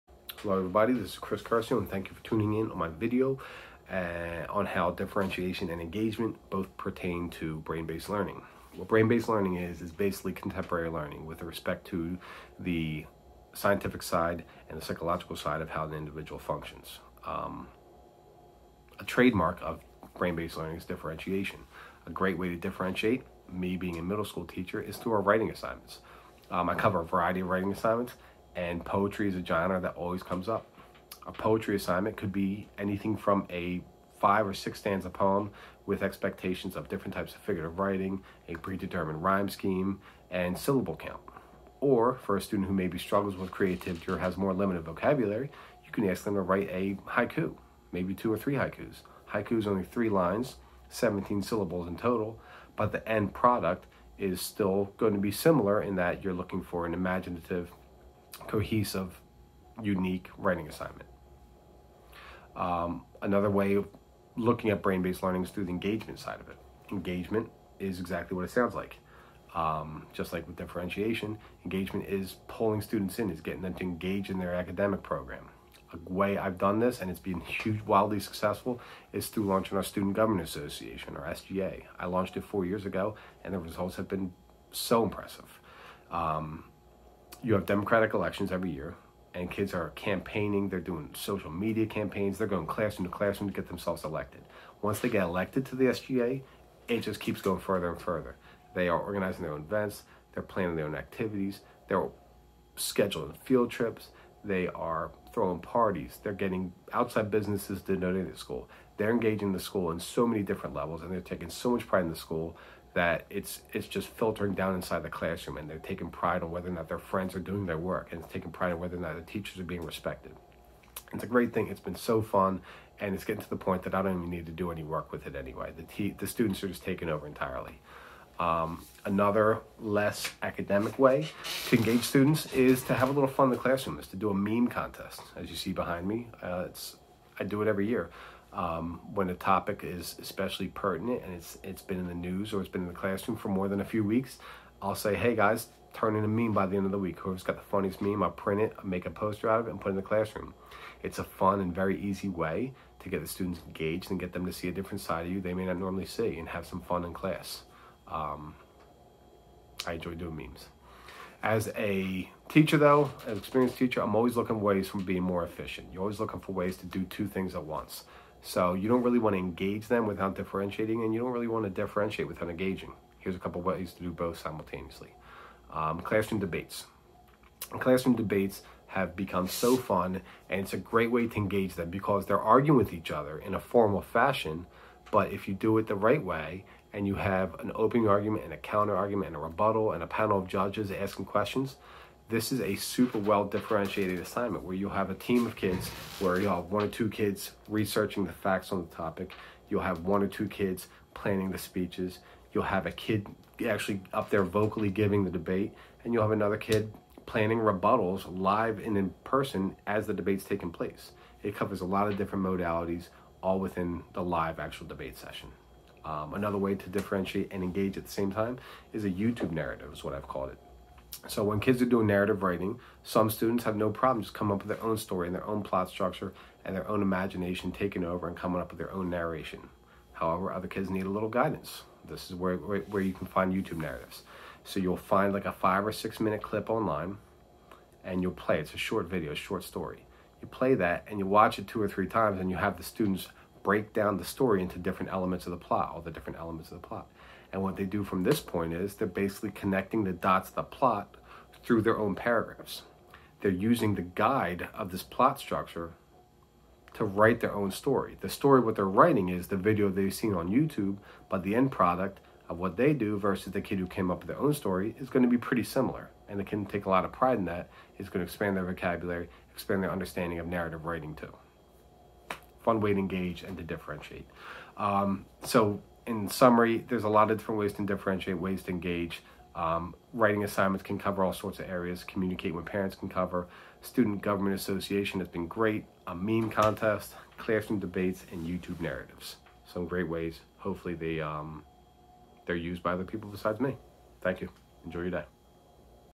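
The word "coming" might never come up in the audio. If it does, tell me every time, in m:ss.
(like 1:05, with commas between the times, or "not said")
3:44, 3:48.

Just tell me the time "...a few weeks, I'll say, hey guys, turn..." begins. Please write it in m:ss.
2:23.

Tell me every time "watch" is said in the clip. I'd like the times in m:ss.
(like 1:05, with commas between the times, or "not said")
4:01.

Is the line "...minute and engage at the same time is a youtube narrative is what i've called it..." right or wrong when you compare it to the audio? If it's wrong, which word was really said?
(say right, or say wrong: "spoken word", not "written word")
wrong: "differentiate", not "minute".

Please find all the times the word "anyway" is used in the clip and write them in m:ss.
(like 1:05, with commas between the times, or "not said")
2:05.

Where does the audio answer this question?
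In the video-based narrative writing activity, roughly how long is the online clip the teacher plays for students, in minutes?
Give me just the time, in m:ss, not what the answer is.
3:55.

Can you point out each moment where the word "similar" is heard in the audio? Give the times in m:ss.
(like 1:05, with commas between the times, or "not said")
0:55, 4:25.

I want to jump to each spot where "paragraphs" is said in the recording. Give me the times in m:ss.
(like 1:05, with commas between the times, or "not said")
4:12.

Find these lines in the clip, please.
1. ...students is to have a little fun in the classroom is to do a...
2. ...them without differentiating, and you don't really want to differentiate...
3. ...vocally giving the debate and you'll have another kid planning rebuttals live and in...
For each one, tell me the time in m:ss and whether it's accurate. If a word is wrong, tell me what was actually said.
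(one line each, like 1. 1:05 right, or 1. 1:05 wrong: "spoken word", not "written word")
1. 2:12 right
2. 2:49 right
3. 3:24 right.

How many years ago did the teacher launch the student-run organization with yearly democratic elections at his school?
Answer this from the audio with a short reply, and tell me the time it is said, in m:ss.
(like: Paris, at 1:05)
4, at 1:22.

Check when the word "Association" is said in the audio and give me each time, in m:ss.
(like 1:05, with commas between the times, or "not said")
1:20, 4:44.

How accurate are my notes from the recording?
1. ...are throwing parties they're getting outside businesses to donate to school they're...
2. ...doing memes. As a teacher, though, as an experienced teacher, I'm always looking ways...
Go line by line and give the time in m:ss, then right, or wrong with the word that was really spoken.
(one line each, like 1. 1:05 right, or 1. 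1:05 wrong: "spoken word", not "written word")
1. 1:44 right
2. 2:40 right.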